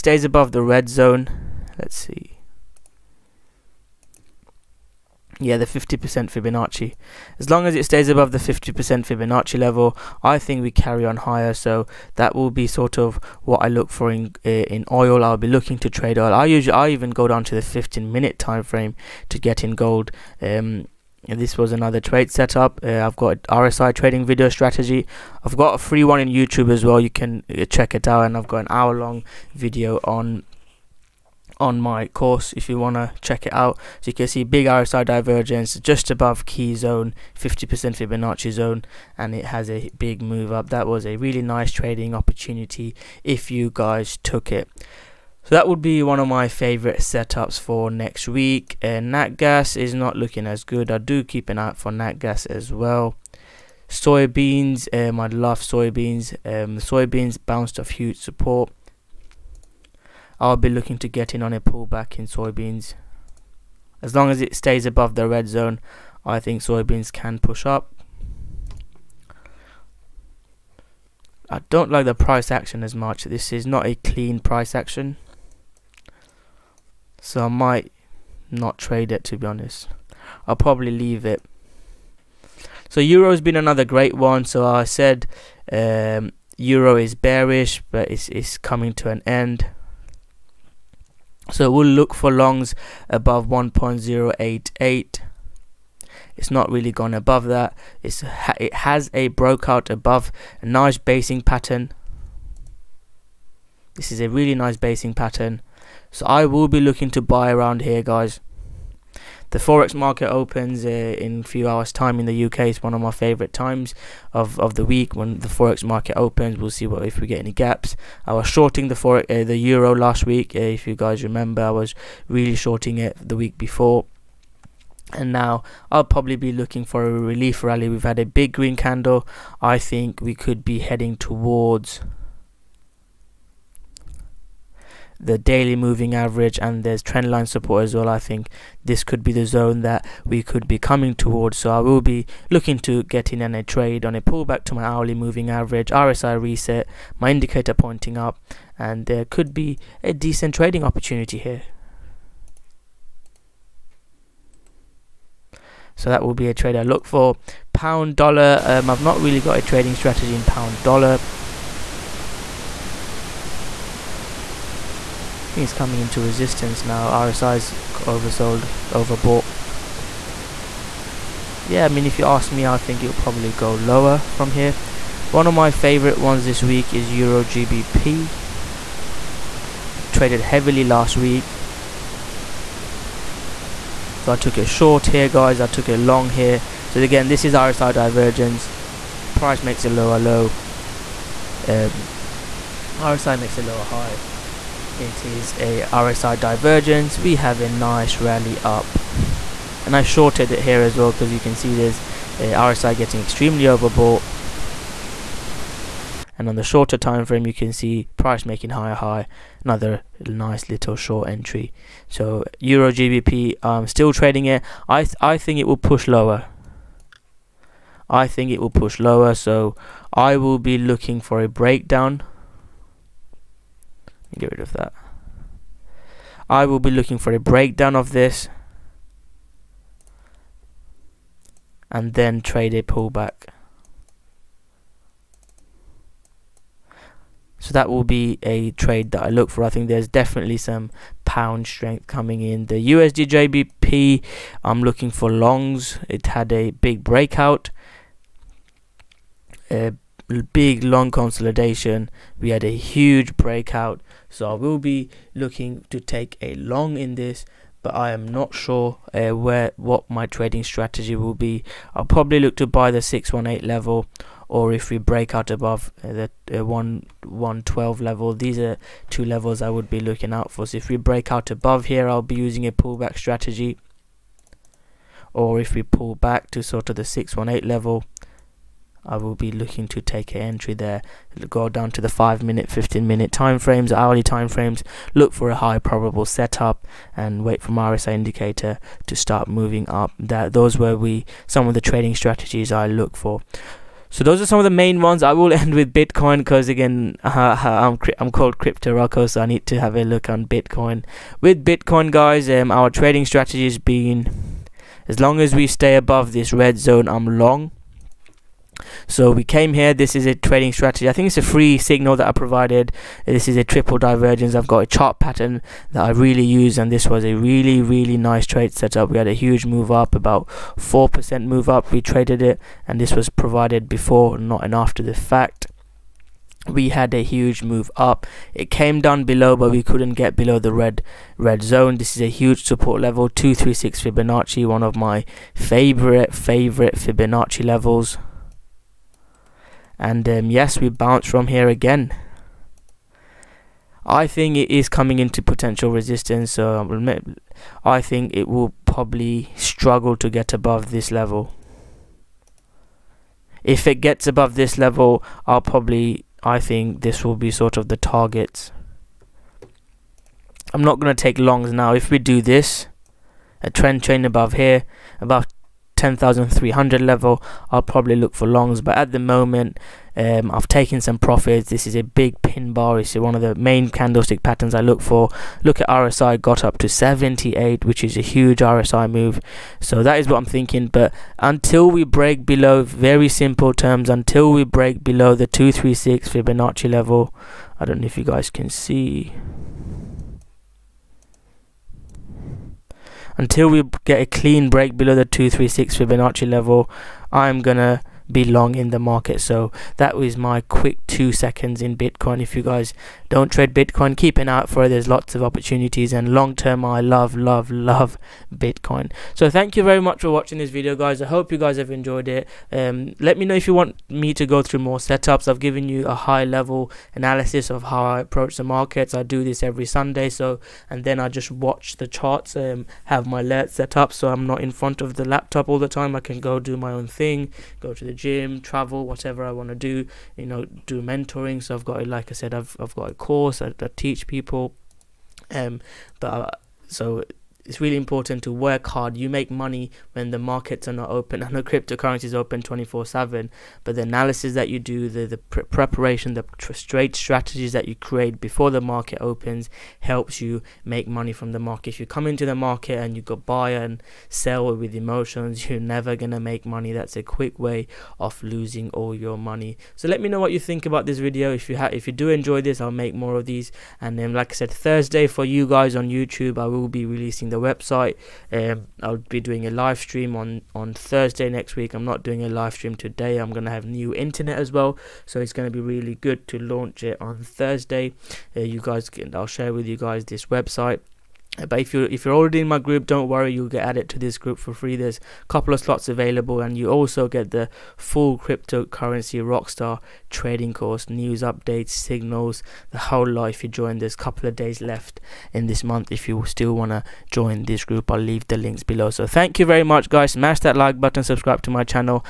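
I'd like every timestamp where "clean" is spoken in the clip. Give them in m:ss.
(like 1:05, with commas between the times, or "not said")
1:13, 6:34.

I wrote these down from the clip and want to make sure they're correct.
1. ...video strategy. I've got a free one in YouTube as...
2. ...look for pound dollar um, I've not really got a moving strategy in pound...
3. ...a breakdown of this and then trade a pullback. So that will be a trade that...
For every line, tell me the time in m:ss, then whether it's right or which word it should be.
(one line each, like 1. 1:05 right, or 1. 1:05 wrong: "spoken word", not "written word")
1. 0:24 right
2. 2:36 wrong: "trading", not "moving"
3. 3:47 right.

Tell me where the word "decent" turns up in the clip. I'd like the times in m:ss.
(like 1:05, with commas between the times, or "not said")
2:30.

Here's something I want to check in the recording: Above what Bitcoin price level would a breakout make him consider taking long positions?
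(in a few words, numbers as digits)
10,300.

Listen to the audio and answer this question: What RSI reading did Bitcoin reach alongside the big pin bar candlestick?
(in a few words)
78.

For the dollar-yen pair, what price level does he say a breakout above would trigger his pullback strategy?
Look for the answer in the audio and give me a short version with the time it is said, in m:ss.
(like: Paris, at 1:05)
112, at 4:26.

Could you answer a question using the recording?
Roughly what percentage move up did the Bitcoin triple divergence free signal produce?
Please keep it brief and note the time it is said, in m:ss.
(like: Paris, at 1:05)
4%, at 5:20.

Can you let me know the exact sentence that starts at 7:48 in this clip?
Um, I'll be doing a live stream on on Thursday next week.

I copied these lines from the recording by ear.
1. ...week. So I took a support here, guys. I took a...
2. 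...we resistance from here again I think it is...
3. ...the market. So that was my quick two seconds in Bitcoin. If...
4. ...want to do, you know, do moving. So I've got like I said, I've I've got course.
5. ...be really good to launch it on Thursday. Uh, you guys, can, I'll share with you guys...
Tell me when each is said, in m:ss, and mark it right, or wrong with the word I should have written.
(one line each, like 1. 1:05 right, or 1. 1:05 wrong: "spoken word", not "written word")
1. 3:01 wrong: "short", not "support"
2. 5:40 wrong: "bounce", not "resistance"
3. 6:38 right
4. 7:09 wrong: "mentoring", not "moving"
5. 7:55 right.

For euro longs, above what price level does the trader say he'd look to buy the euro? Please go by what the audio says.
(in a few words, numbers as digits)
1.088.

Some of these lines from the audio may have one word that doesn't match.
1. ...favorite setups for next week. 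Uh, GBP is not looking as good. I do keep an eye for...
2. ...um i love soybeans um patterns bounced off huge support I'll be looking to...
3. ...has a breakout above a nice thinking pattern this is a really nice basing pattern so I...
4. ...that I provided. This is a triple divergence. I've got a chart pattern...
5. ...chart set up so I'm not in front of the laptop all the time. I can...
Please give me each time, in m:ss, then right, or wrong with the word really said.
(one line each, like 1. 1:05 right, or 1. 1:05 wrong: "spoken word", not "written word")
1. 0:46 wrong: "Natgas", not "GBP"
2. 0:54 wrong: "soybeans", not "patterns"
3. 1:38 wrong: "basing", not "thinking"
4. 5:12 right
5. 7:03 wrong: "alert", not "chart".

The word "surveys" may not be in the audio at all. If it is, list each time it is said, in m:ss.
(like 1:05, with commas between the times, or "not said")
not said.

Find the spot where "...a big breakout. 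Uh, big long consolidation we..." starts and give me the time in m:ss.
4:06.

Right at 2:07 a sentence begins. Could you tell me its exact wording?
We've had a big green candle.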